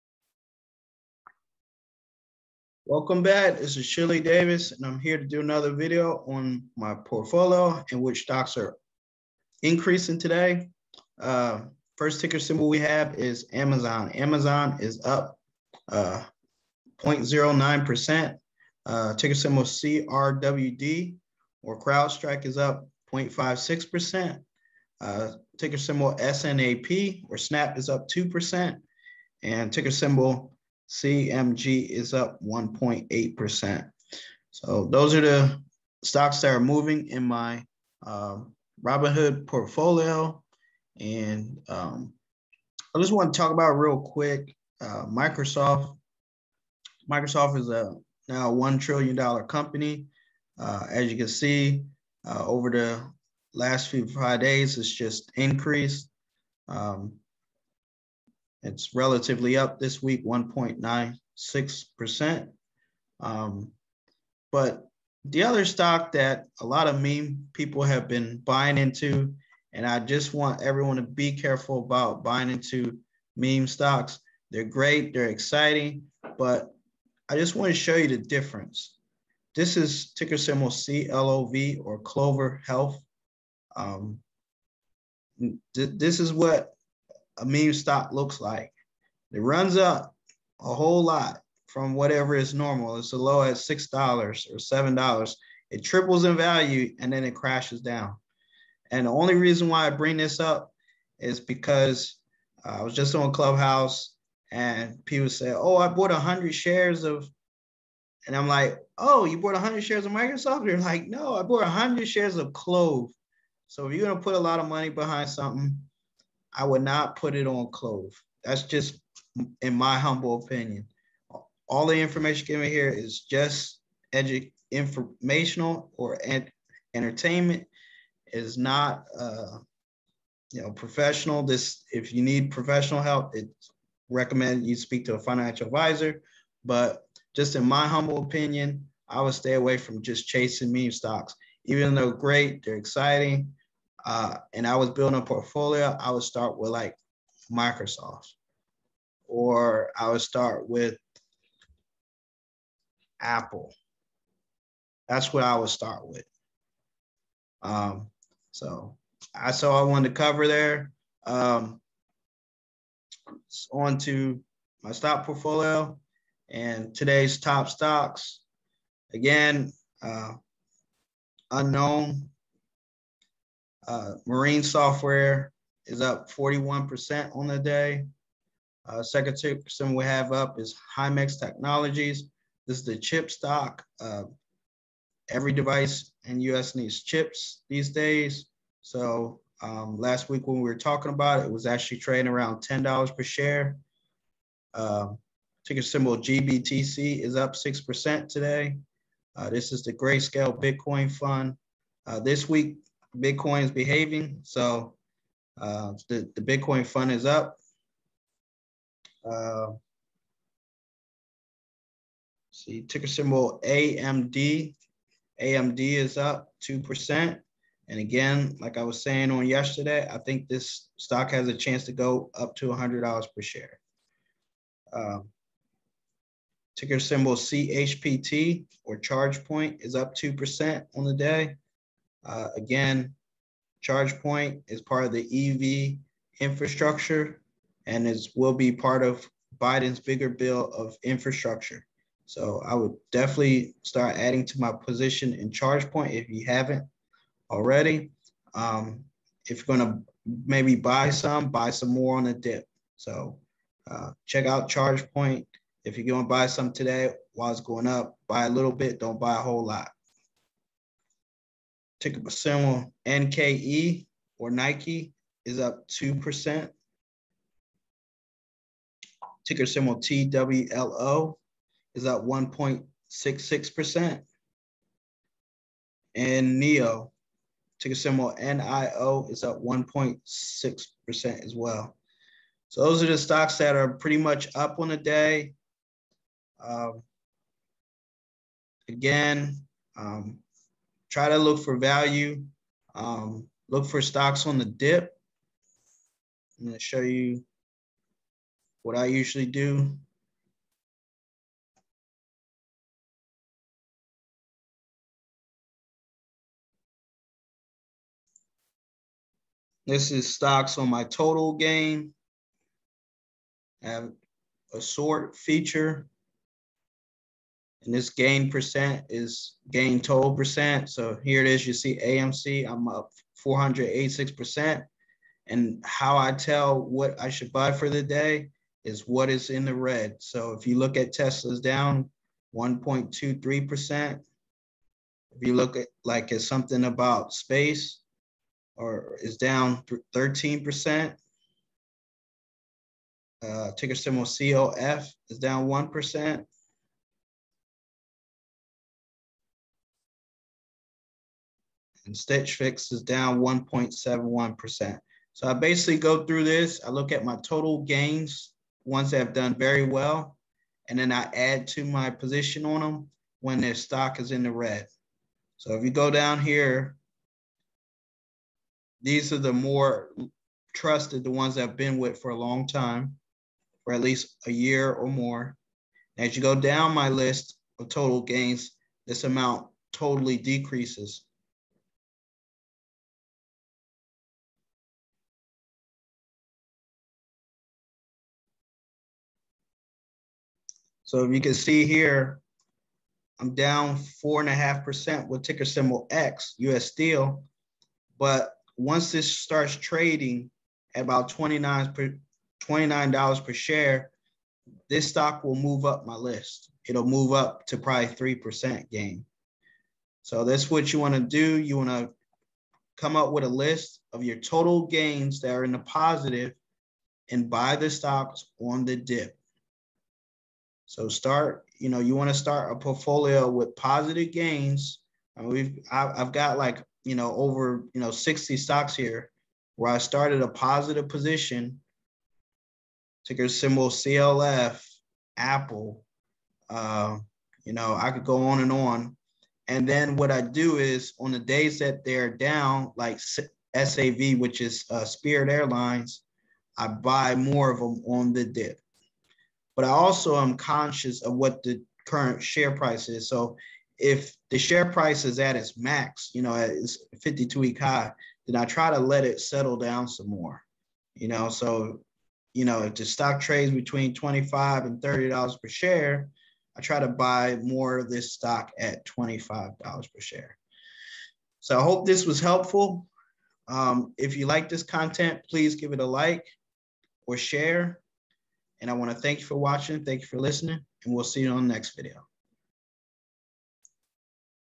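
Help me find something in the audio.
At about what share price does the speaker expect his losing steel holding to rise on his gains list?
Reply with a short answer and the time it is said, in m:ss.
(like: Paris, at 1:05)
$29, at 6:42.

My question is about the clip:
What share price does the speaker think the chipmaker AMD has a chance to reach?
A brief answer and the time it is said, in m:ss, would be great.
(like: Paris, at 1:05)
$100, at 3:42.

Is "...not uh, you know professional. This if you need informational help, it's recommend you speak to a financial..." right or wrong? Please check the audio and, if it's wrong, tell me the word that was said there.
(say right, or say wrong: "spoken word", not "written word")
wrong: "professional", not "informational".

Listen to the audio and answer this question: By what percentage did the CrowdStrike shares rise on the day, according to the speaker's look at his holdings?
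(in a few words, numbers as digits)
0.56%.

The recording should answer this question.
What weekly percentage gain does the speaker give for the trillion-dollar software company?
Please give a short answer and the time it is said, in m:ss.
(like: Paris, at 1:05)
1.96%, at 1:00.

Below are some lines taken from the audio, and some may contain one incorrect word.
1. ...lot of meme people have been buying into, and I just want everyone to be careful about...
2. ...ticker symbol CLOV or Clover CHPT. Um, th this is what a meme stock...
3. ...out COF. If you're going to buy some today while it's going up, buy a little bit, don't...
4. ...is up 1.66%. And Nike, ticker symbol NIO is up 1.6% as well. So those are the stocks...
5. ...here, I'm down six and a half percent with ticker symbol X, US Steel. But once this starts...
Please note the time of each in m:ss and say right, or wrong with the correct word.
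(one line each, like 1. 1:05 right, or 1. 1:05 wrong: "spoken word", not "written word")
1. 1:06 right
2. 1:20 wrong: "Health", not "CHPT"
3. 4:14 wrong: "ChargePoint", not "COF"
4. 4:31 wrong: "NEO", not "Nike"
5. 6:31 wrong: "four", not "six".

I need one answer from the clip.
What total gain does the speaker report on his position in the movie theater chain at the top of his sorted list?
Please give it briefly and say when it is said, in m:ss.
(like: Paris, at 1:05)
486%, at 5:23.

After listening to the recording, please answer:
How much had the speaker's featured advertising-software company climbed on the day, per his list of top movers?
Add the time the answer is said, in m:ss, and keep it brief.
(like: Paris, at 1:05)
41%, at 2:56.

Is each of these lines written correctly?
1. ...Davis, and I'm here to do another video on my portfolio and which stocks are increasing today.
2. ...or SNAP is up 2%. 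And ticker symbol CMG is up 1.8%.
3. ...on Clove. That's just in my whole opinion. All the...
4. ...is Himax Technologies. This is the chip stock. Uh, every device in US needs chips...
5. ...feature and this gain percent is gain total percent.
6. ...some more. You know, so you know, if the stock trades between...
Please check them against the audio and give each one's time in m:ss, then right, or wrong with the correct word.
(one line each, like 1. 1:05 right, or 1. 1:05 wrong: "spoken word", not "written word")
1. 0:04 right
2. 0:27 right
3. 1:57 wrong: "humble", not "whole"
4. 3:00 right
5. 5:15 right
6. 7:40 right.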